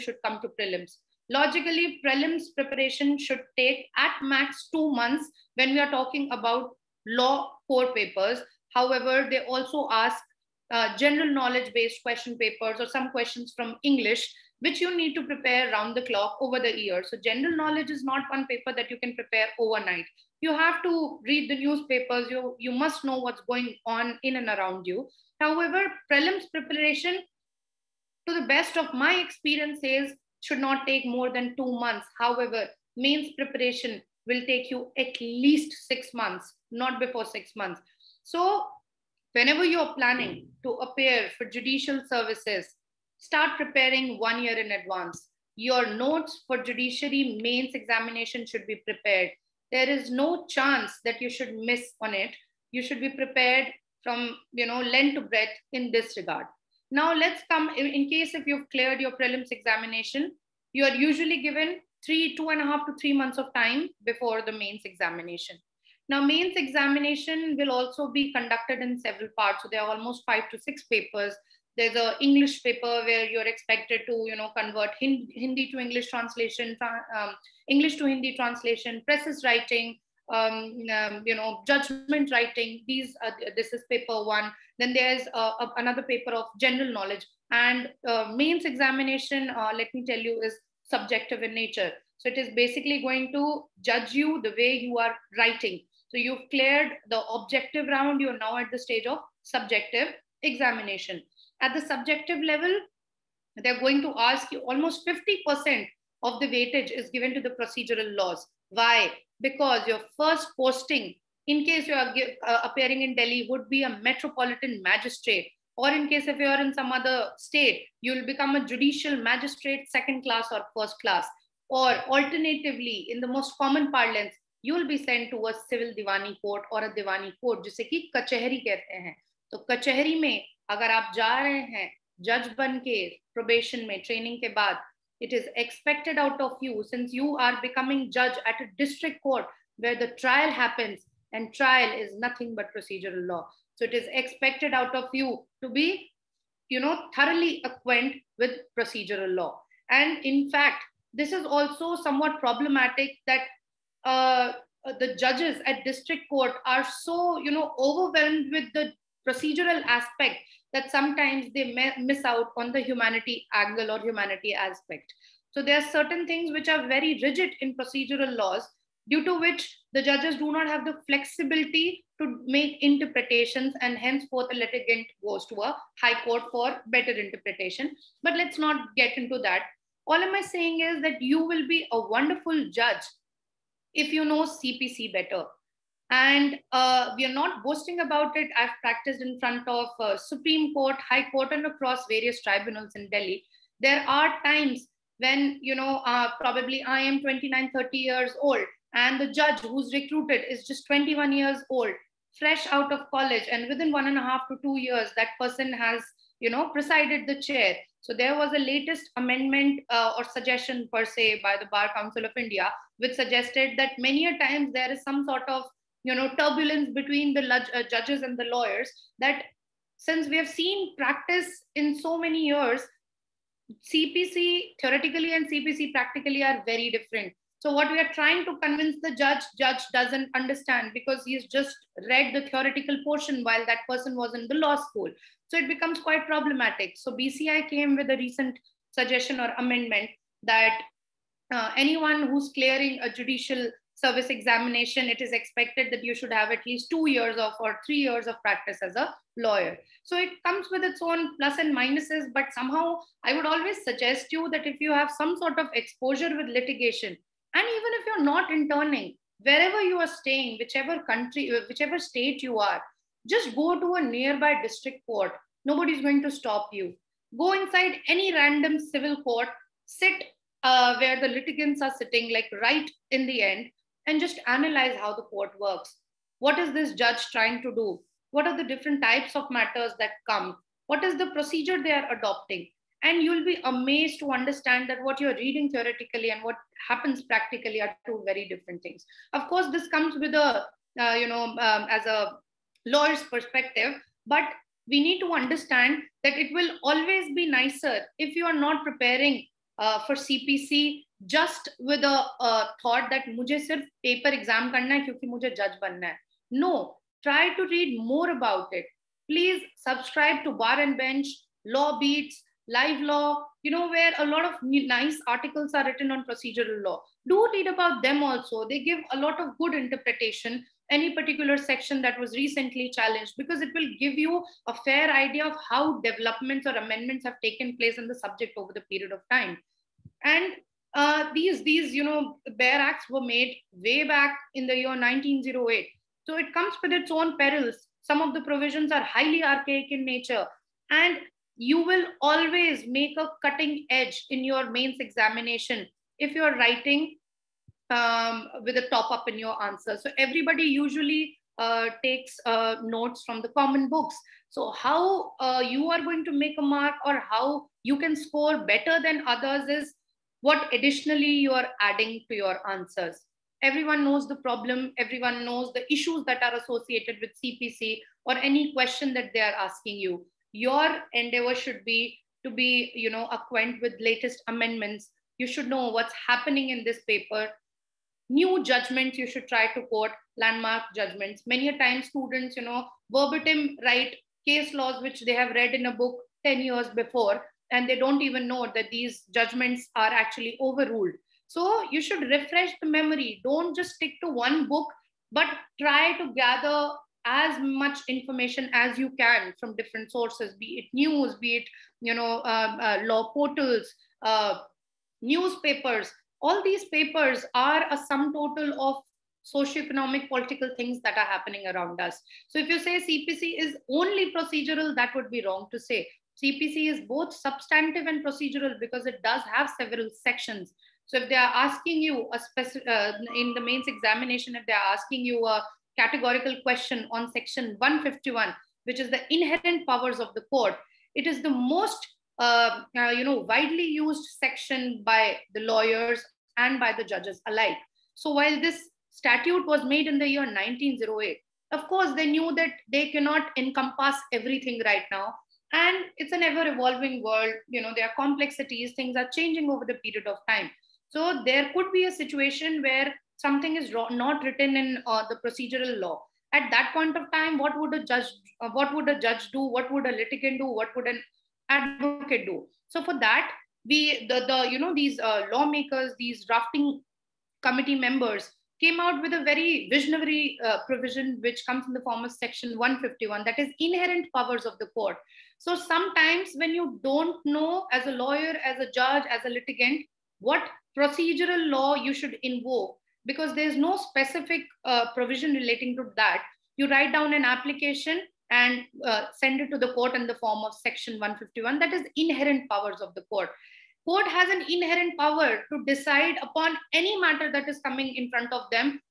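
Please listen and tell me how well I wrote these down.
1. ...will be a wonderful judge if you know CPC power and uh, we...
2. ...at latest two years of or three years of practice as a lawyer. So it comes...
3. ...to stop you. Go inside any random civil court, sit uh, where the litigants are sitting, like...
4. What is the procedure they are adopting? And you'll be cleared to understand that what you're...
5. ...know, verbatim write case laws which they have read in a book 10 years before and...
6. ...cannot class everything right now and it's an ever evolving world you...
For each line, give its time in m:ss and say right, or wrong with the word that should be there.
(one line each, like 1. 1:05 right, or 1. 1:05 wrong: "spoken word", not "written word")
1. 3:01 wrong: "better", not "power"
2. 4:06 wrong: "least", not "latest"
3. 4:26 right
4. 4:40 wrong: "amazed", not "cleared"
5. 6:22 right
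6. 7:23 wrong: "encompass", not "class".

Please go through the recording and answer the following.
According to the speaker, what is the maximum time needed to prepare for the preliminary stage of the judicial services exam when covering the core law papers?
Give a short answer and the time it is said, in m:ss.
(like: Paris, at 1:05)
2 months, at 0:04.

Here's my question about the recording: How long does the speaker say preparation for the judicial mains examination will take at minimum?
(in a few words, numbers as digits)
6 months.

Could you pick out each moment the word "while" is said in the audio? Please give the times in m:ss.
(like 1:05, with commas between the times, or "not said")
3:53, 7:18.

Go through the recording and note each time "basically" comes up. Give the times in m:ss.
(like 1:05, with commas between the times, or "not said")
1:32.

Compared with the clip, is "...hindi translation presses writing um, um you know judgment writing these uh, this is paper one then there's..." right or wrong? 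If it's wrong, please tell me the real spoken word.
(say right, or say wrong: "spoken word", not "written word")
right.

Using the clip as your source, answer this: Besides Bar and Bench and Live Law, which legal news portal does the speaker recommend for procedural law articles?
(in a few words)
Law Beats.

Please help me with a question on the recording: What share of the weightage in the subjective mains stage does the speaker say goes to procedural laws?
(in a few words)
50%.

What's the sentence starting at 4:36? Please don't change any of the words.
What is this judge trying to do?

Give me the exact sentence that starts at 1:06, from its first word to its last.
Now, mains examination will also be conducted in several parts.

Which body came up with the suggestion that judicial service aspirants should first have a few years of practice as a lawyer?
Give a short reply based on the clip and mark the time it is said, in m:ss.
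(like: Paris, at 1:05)
Bar Council of India, at 3:31.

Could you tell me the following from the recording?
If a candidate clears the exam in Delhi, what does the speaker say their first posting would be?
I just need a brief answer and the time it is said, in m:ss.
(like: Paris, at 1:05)
Metropolitan magistrate, at 1:54.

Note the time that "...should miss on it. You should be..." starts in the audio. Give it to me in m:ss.
0:51.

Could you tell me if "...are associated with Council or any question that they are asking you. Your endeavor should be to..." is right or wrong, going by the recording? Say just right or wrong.
wrong.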